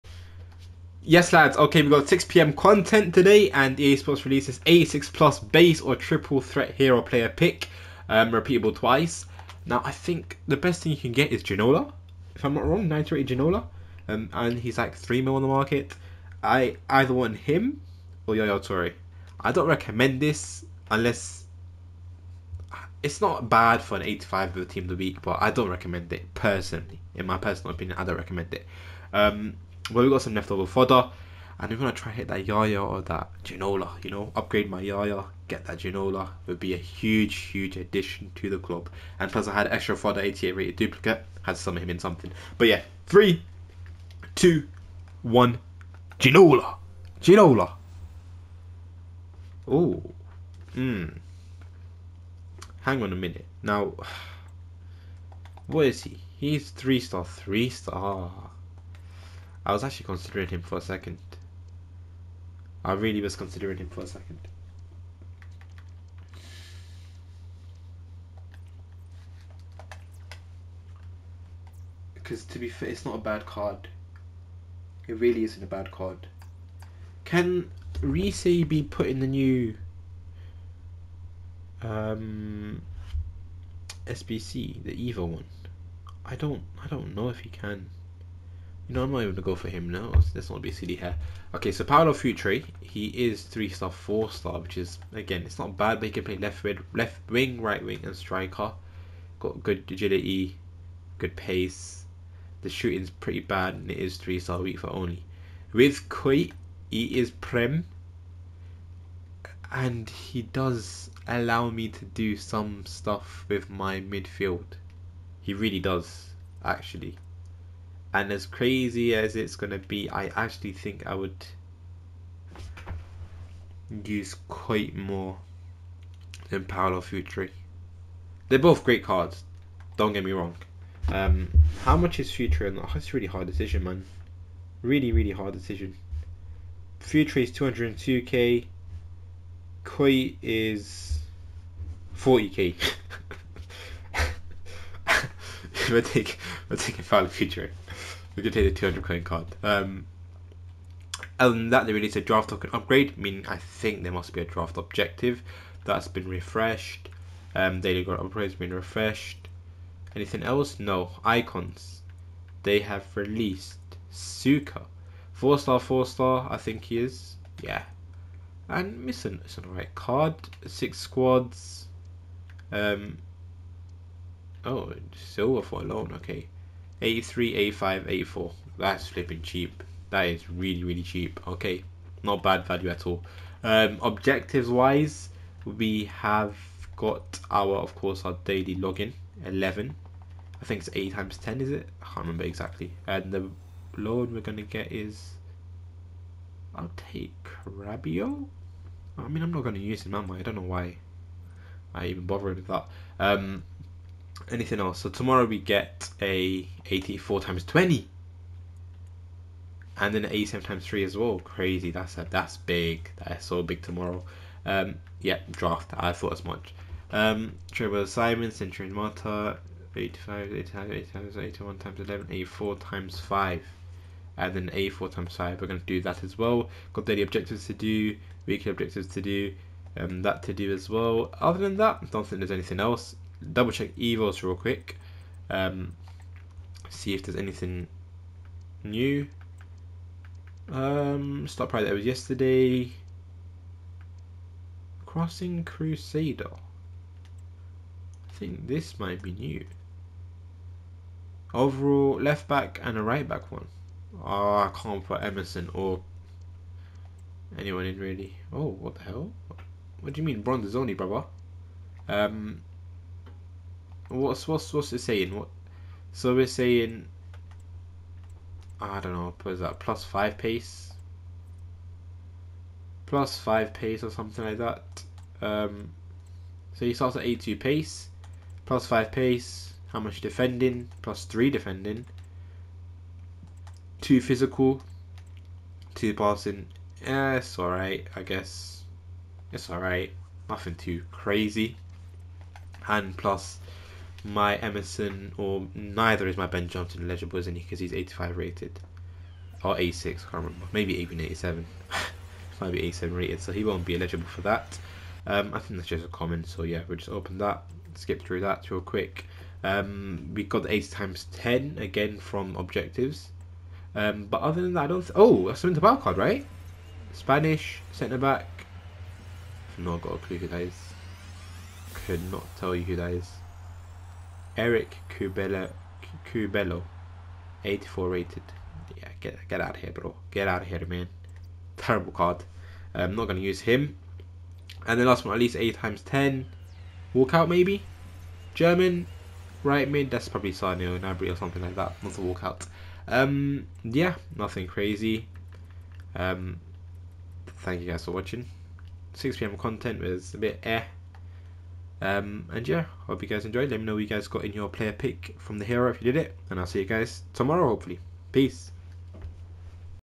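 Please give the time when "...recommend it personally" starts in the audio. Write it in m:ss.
0:25.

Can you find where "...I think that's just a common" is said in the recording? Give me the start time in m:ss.
5:05.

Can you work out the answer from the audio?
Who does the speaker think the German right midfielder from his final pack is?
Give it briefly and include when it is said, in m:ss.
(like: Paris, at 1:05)
Gnabry, at 5:40.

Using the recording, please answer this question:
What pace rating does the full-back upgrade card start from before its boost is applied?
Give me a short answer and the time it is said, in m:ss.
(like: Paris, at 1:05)
82, at 4:37.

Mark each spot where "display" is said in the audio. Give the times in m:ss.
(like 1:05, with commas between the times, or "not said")
not said.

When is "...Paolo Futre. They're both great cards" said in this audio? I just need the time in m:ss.
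2:06.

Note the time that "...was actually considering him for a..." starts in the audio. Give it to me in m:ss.
0:59.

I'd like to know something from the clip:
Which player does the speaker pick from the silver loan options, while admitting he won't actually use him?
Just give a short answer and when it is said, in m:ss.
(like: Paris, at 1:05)
Rabiot, at 3:17.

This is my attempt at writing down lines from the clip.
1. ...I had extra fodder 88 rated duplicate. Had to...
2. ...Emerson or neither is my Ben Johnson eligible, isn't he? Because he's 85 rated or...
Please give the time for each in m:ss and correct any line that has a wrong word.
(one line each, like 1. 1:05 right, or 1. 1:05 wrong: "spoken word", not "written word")
1. 0:39 right
2. 4:54 right.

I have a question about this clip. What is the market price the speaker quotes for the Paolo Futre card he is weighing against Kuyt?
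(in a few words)
202k.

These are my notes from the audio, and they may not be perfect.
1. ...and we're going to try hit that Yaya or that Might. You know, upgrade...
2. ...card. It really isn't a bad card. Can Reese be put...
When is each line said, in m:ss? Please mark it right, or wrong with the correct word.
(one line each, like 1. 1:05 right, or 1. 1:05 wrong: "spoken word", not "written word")
1. 0:31 wrong: "Ginola", not "Might"
2. 1:13 right.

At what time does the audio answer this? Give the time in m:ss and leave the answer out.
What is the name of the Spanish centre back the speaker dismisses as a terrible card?
5:24.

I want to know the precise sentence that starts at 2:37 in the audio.
Um, daily upgrade has been refreshed.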